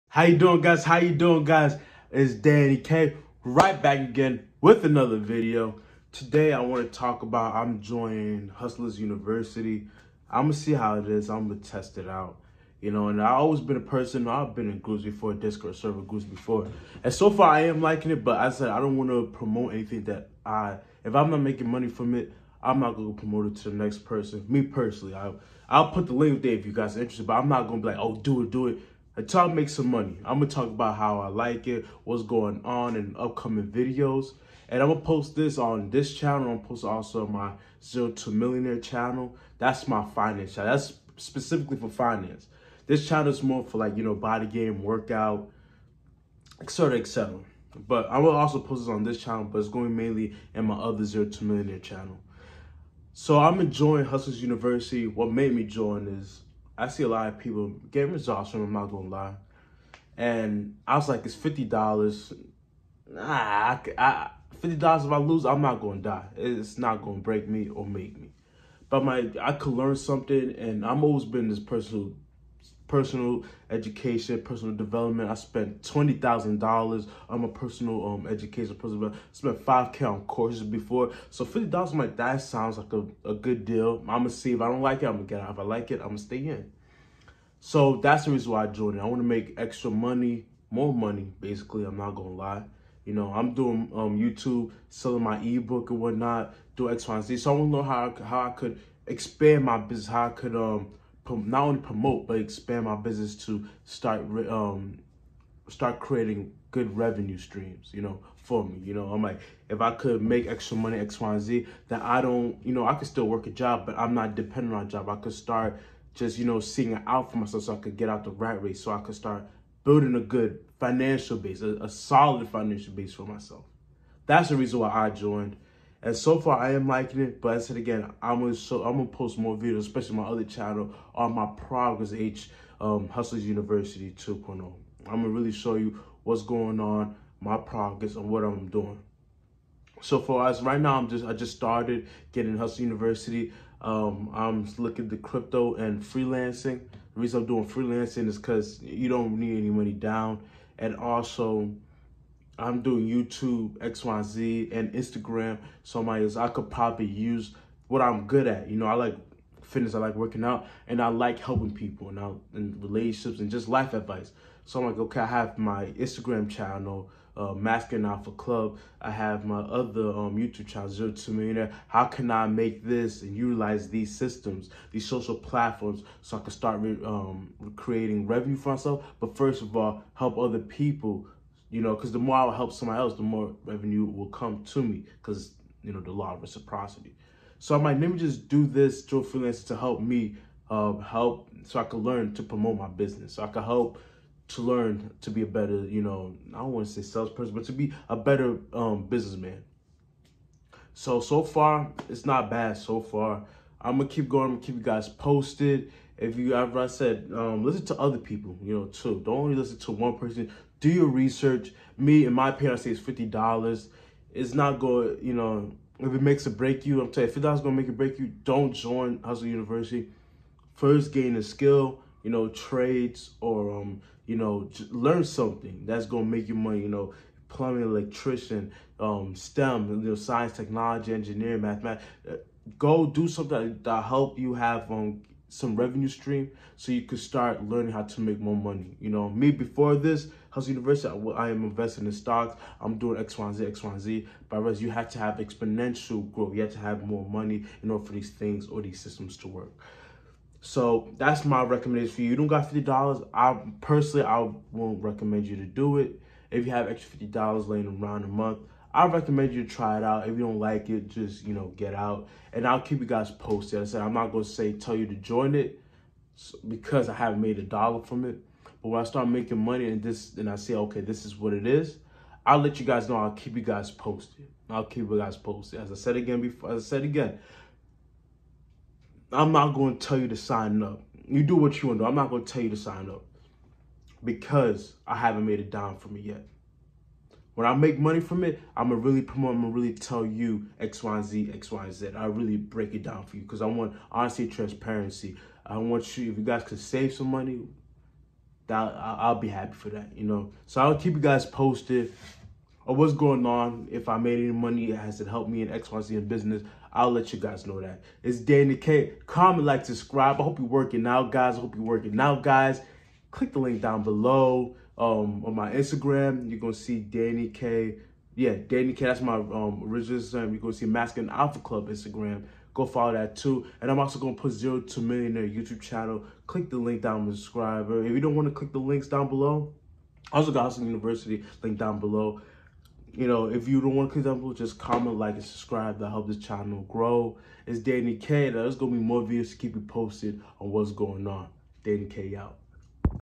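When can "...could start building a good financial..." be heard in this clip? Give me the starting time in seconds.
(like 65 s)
118 s.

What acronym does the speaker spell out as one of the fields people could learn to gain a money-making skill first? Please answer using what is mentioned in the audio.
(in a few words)
STEM.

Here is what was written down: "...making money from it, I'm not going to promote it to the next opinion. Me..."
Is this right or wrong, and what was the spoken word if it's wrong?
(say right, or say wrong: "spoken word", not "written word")
wrong: "person", not "opinion".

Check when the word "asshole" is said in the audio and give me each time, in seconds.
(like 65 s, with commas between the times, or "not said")
not said.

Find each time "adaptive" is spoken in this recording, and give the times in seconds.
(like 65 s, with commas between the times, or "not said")
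not said.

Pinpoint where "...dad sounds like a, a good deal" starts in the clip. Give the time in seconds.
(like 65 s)
82 s.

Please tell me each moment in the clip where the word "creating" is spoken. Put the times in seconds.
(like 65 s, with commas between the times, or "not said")
105 s, 177 s.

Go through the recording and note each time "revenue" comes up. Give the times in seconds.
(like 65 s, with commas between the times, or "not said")
106 s, 178 s, 183 s, 235 s.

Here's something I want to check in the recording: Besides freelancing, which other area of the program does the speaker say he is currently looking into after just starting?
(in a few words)
Crypto.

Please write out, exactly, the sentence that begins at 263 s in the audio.
I said, I'm not going to say tell you to join it because I haven't made a dollar from it.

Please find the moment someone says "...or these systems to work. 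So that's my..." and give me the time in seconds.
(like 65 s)
248 s.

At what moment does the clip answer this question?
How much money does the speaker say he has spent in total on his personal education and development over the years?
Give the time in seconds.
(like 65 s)
75 s.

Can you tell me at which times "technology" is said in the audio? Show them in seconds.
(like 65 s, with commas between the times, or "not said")
230 s.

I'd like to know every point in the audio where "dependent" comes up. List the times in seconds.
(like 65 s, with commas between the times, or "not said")
114 s.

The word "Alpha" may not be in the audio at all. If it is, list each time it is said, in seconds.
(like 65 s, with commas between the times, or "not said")
168 s, 321 s.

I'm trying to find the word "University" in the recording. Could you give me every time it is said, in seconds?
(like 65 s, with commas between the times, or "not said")
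8 s, 54 s, 133 s, 142 s, 219 s, 240 s, 330 s.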